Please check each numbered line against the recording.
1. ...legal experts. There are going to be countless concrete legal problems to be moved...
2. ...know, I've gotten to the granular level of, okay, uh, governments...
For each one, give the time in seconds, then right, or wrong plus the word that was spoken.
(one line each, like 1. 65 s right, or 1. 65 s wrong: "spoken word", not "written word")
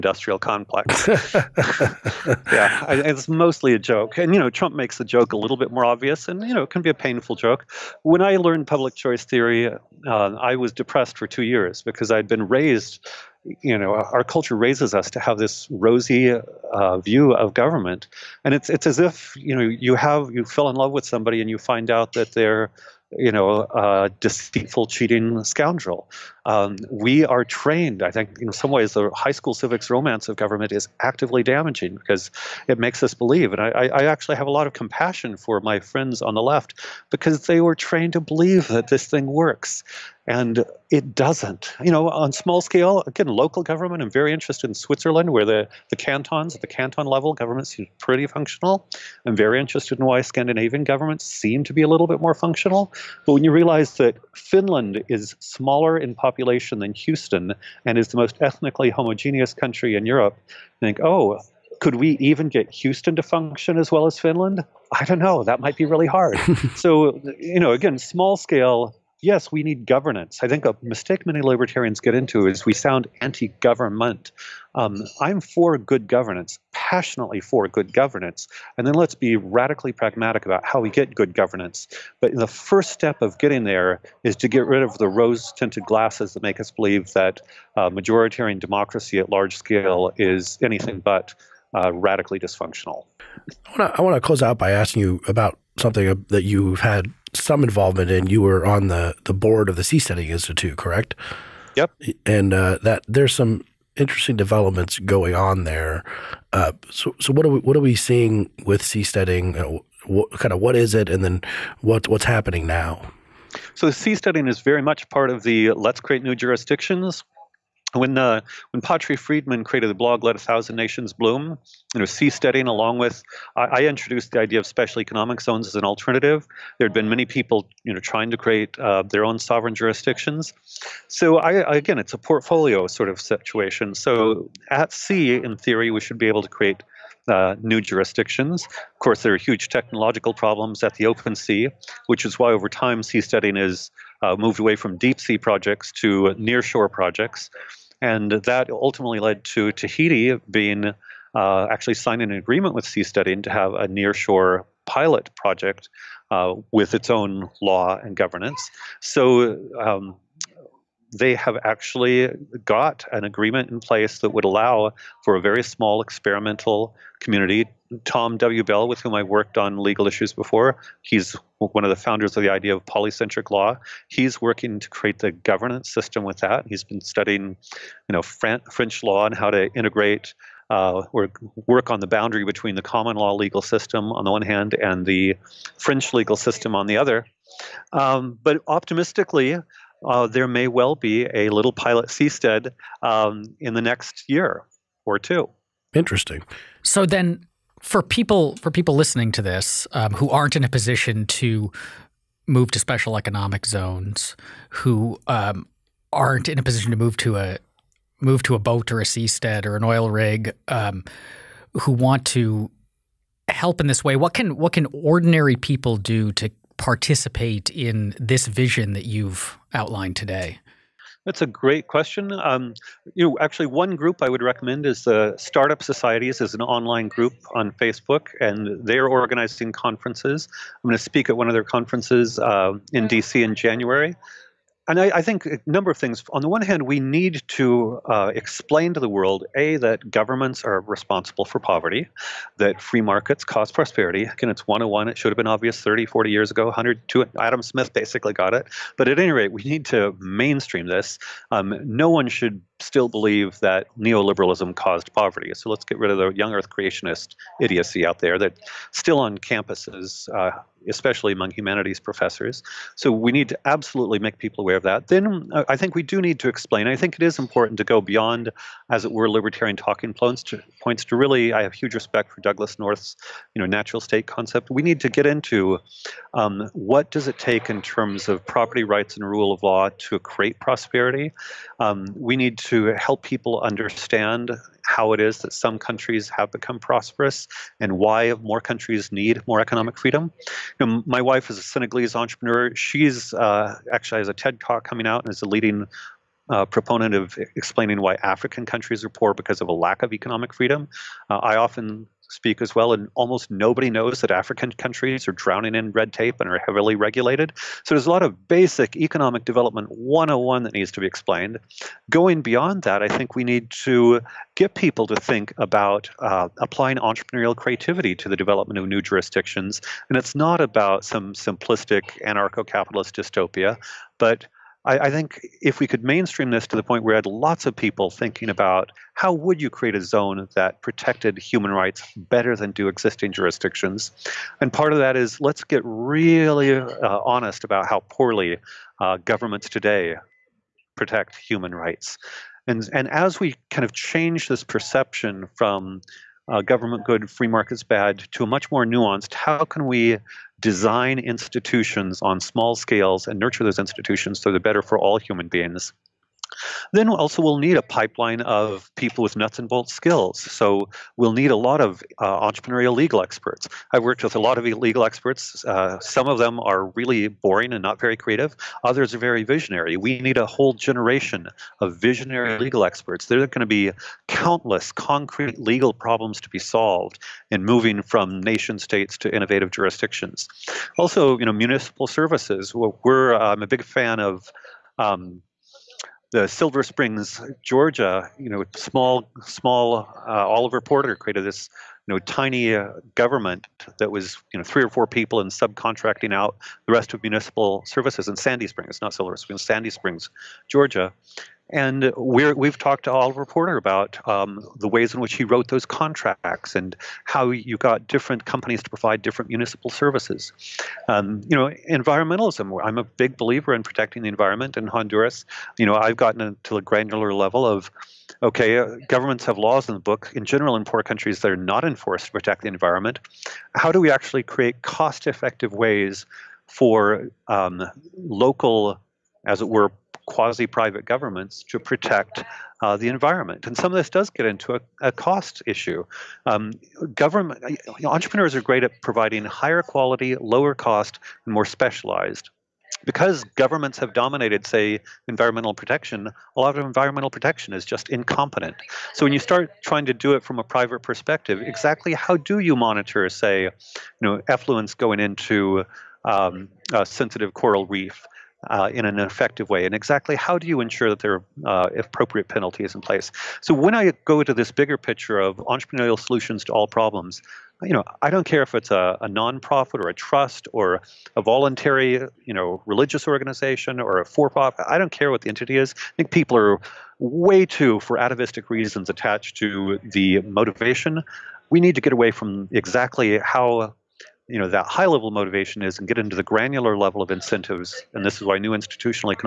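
1. 372 s wrong: "solved", not "moved"
2. 415 s right.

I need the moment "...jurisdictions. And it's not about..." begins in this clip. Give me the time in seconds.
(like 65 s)
319 s.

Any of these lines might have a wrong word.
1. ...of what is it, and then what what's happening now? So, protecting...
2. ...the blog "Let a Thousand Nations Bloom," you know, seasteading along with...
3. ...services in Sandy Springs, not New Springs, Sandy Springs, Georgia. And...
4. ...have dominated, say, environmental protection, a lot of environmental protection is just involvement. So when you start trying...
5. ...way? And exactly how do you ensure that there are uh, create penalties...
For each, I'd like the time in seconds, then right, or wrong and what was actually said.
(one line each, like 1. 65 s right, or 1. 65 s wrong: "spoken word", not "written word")
1. 110 s wrong: "seasteading", not "protecting"
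2. 119 s right
3. 397 s wrong: "Silver", not "New"
4. 443 s wrong: "incompetent", not "involvement"
5. 459 s wrong: "appropriate", not "create".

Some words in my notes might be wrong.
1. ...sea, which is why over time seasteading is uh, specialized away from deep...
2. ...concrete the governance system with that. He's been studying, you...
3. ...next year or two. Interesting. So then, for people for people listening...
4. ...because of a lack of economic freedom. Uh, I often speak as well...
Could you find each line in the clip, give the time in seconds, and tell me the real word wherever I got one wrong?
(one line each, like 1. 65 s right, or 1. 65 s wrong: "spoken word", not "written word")
1. 141 s wrong: "moved", not "specialized"
2. 174 s wrong: "create", not "concrete"
3. 193 s right
4. 299 s right.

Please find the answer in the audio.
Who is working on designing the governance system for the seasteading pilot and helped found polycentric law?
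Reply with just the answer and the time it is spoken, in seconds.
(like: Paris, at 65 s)
Tom W. Bell, at 168 s.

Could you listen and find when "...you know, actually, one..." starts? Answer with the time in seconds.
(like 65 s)
223 s.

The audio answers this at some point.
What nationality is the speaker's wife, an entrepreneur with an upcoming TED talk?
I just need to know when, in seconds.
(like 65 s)
291 s.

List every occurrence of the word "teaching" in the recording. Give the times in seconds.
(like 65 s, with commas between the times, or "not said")
not said.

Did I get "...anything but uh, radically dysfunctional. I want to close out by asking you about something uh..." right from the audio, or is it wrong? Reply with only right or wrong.
right.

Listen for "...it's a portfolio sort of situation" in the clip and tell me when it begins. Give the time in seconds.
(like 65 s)
131 s.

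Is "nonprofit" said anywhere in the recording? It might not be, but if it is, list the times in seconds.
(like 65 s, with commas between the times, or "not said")
469 s.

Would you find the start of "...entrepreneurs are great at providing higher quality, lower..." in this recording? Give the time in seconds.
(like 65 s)
438 s.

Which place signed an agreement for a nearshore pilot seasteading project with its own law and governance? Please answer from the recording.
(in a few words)
Tahiti.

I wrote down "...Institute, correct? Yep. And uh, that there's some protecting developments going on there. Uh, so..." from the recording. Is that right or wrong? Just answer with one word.
wrong.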